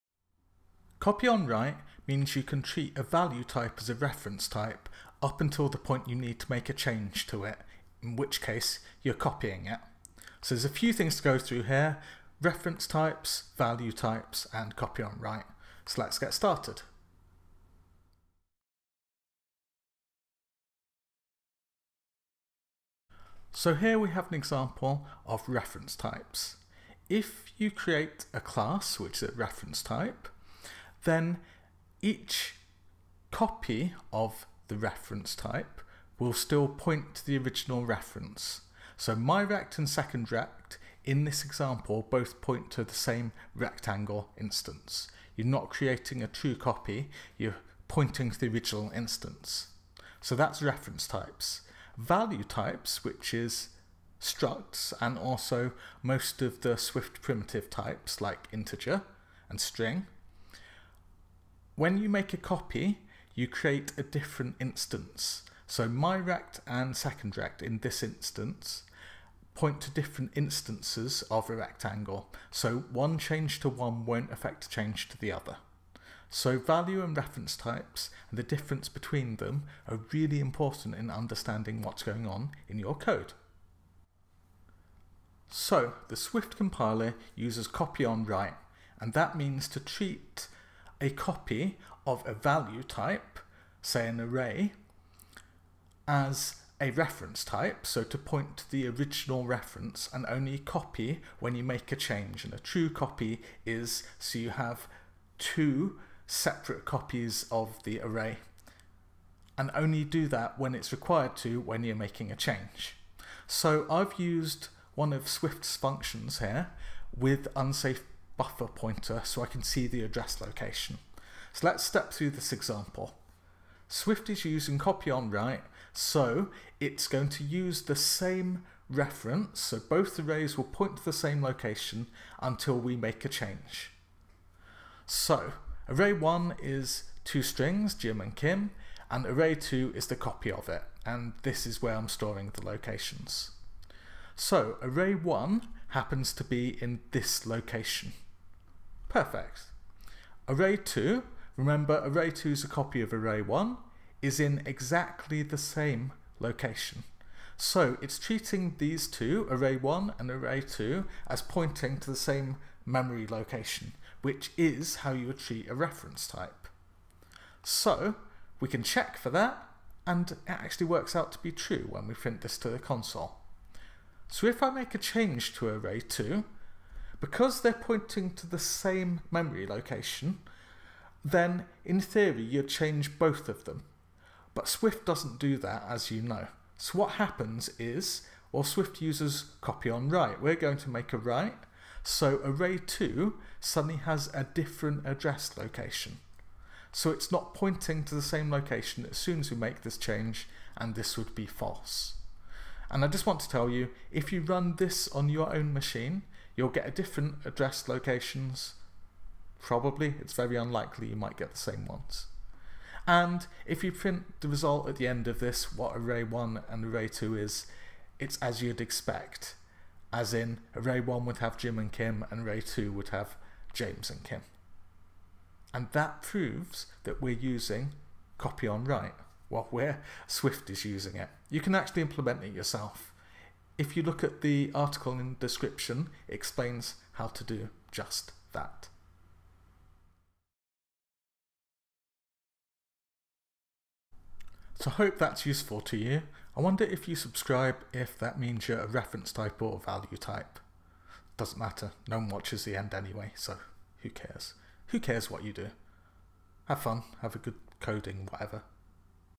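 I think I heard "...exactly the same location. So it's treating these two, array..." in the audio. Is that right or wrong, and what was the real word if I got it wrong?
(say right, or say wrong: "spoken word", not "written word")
right.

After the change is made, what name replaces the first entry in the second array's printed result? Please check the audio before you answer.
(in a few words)
James.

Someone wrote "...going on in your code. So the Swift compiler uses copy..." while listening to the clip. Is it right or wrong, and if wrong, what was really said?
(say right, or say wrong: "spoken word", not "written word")
right.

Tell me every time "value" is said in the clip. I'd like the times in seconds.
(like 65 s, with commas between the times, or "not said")
3 s, 13 s, 51 s, 76 s, 92 s, 249 s.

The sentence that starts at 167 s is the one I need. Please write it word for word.
So we can check for that, and it actually works out to be true when we print this to the console.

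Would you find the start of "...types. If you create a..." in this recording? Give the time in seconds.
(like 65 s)
25 s.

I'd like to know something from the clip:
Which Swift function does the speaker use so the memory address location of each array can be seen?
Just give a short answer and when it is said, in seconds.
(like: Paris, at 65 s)
unsafe buffer pointer, at 117 s.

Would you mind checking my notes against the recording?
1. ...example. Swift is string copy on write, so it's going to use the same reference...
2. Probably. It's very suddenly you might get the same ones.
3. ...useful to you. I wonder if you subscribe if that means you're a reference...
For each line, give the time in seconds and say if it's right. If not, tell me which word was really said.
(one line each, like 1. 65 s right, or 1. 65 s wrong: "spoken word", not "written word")
1. 122 s wrong: "using", not "string"
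2. 209 s wrong: "unlikely", not "suddenly"
3. 245 s right.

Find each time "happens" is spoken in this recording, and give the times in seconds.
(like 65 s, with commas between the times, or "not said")
145 s, 187 s.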